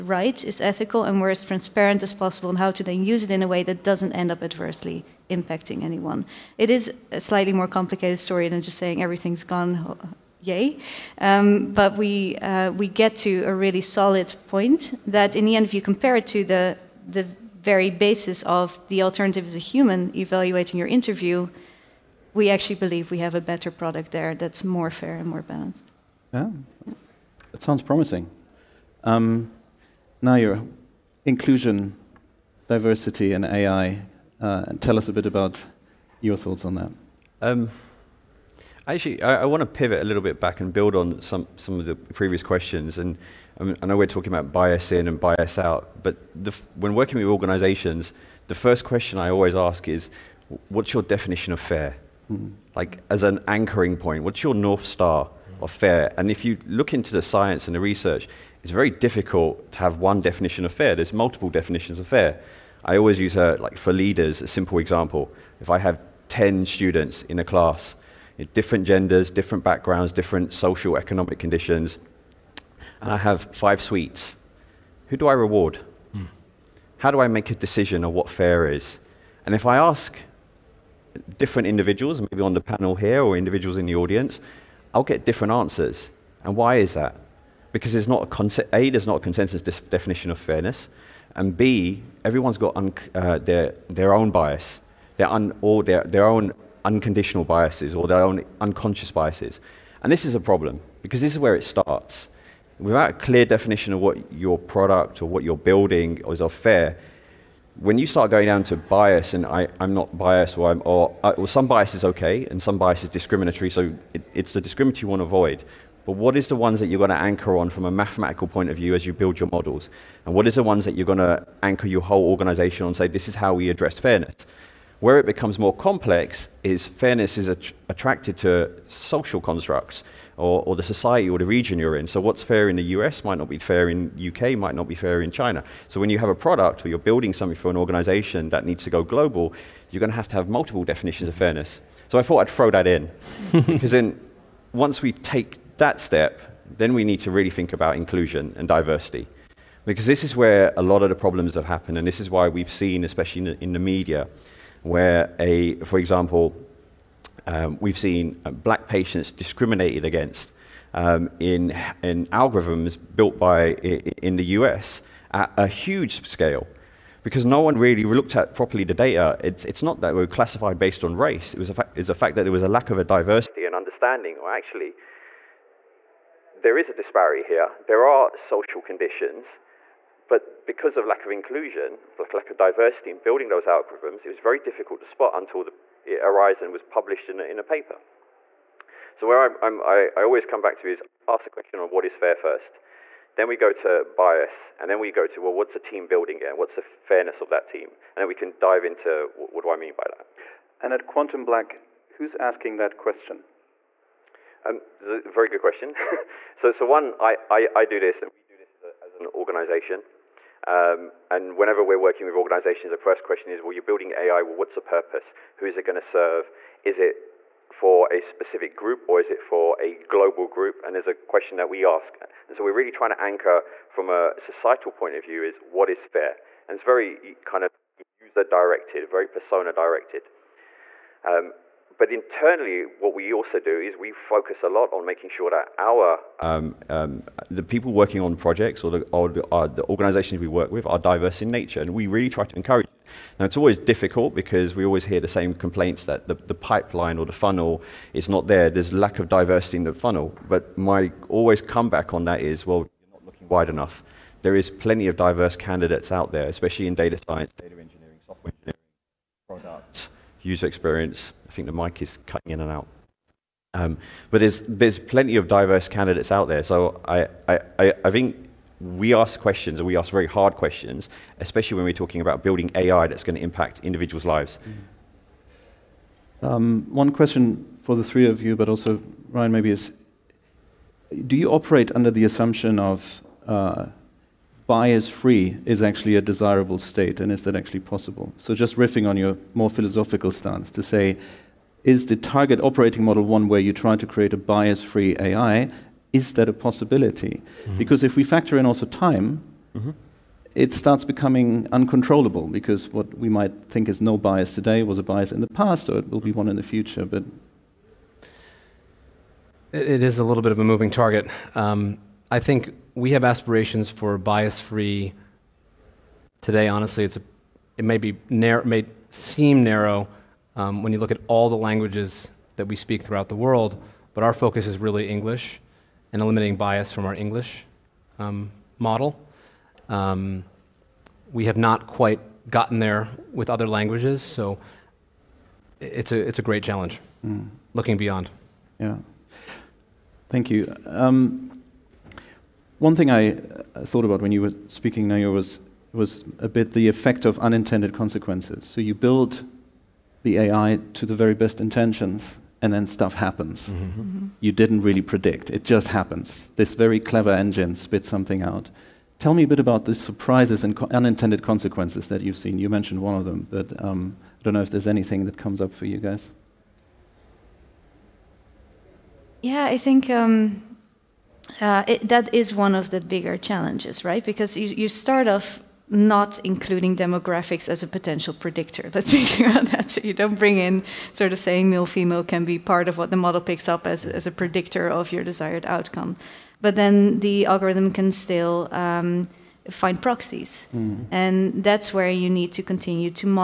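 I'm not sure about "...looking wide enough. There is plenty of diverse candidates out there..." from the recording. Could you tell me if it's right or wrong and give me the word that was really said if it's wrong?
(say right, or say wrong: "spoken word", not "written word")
right.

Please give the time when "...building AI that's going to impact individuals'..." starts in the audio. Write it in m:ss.
4:32.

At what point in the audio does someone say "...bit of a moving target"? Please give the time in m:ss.
5:10.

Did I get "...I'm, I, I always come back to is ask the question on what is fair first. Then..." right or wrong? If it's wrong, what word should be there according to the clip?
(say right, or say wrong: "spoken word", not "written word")
right.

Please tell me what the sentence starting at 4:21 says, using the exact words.
I think the mic is cutting in and out.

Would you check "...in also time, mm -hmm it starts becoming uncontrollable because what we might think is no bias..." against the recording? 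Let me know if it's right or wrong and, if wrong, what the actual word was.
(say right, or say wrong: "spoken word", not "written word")
right.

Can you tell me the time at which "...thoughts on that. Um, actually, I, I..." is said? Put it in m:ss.
0:36.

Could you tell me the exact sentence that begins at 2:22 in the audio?
So I thought I'd throw that in.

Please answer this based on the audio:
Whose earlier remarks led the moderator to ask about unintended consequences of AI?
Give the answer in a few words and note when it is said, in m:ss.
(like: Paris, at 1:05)
Nayur, at 5:45.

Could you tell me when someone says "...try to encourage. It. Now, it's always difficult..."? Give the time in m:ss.
4:02.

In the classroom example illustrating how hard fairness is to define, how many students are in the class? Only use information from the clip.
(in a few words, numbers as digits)
10.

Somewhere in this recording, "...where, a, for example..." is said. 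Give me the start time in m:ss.
2:34.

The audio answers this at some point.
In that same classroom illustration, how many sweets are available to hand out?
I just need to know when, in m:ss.
1:13.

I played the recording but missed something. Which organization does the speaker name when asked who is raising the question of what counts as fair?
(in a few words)
QuantumBlack.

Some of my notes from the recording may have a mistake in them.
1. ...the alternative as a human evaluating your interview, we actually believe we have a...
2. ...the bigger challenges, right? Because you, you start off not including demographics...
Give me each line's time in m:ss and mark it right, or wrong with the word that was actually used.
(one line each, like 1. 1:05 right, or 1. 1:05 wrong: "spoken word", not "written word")
1. 0:18 right
2. 6:12 right.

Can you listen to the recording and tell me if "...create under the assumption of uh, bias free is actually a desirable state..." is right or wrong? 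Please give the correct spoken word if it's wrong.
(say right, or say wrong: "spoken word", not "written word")
wrong: "operate", not "create".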